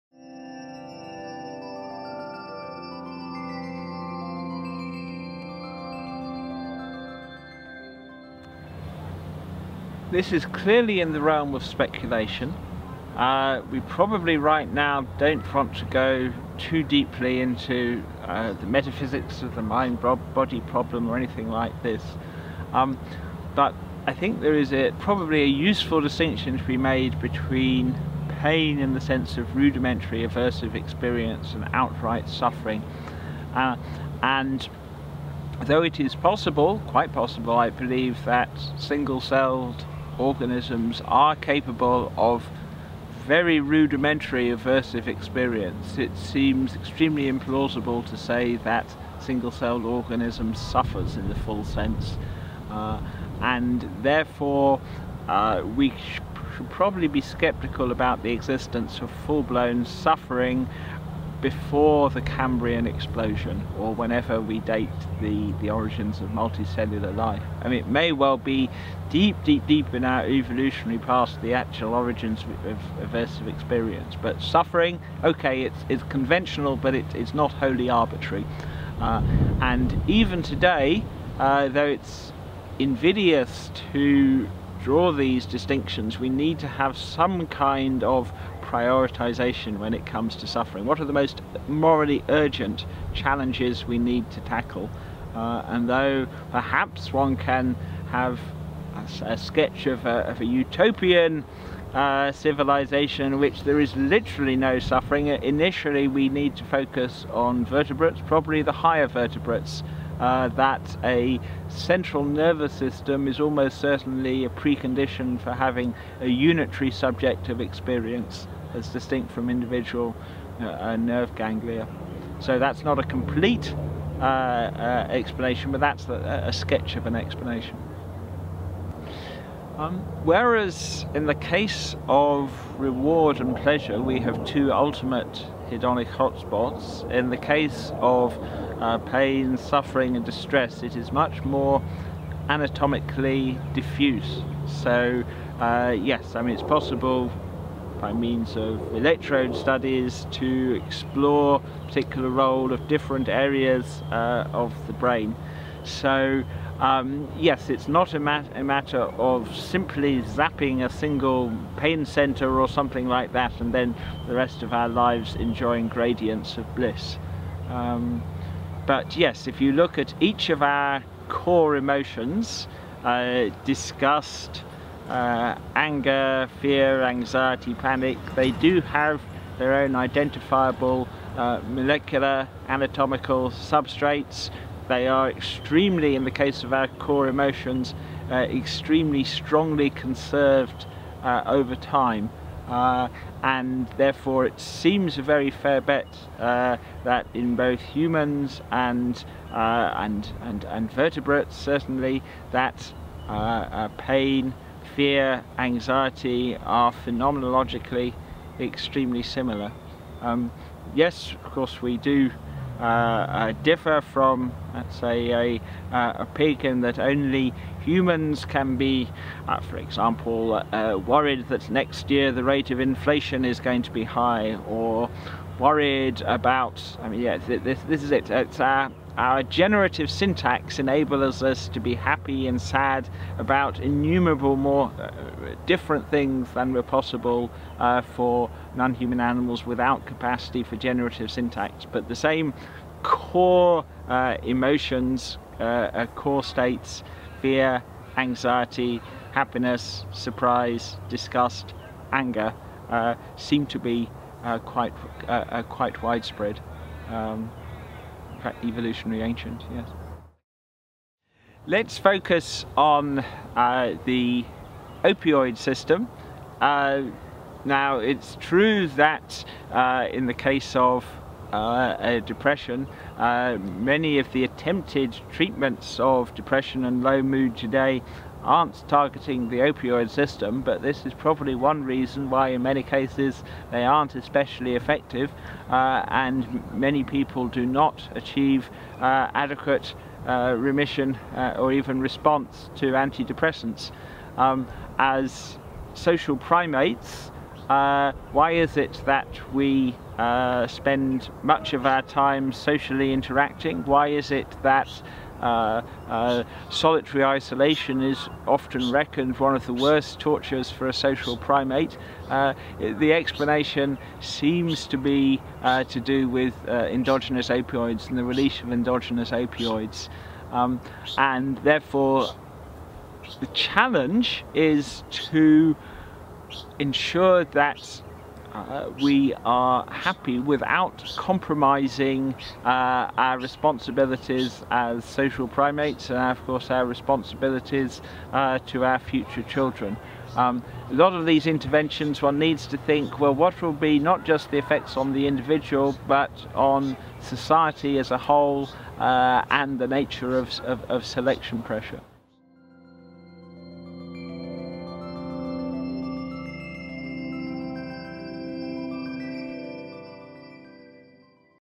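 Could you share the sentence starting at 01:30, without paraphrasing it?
What are the most morally urgent challenges we need to tackle?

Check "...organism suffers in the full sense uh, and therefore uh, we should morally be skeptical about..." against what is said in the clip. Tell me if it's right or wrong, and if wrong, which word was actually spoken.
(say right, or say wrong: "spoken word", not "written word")
wrong: "probably", not "morally".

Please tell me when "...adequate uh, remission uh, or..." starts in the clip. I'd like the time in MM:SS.
04:49.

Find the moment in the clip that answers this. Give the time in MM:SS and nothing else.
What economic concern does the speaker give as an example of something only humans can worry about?
03:42.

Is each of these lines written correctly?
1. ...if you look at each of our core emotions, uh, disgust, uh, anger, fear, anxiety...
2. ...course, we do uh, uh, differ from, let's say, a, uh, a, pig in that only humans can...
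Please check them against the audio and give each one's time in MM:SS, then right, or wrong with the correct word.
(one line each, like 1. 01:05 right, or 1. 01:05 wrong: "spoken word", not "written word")
1. 02:49 right
2. 03:31 right.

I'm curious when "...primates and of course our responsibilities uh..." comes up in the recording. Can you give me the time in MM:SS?
05:35.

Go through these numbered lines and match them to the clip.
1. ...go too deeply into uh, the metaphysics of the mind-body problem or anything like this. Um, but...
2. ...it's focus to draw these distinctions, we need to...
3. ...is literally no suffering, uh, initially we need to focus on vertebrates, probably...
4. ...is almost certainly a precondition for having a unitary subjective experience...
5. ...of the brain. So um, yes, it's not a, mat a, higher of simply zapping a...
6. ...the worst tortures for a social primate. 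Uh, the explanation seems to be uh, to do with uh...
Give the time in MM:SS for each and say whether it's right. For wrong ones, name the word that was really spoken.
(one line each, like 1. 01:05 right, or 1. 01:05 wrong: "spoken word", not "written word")
1. 00:15 right
2. 01:21 wrong: "invidious", not "focus"
3. 01:43 right
4. 01:53 right
5. 02:34 wrong: "matter", not "higher"
6. 05:09 right.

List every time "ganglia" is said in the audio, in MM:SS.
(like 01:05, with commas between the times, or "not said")
02:01.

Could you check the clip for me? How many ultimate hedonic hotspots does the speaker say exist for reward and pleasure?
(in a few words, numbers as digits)
2.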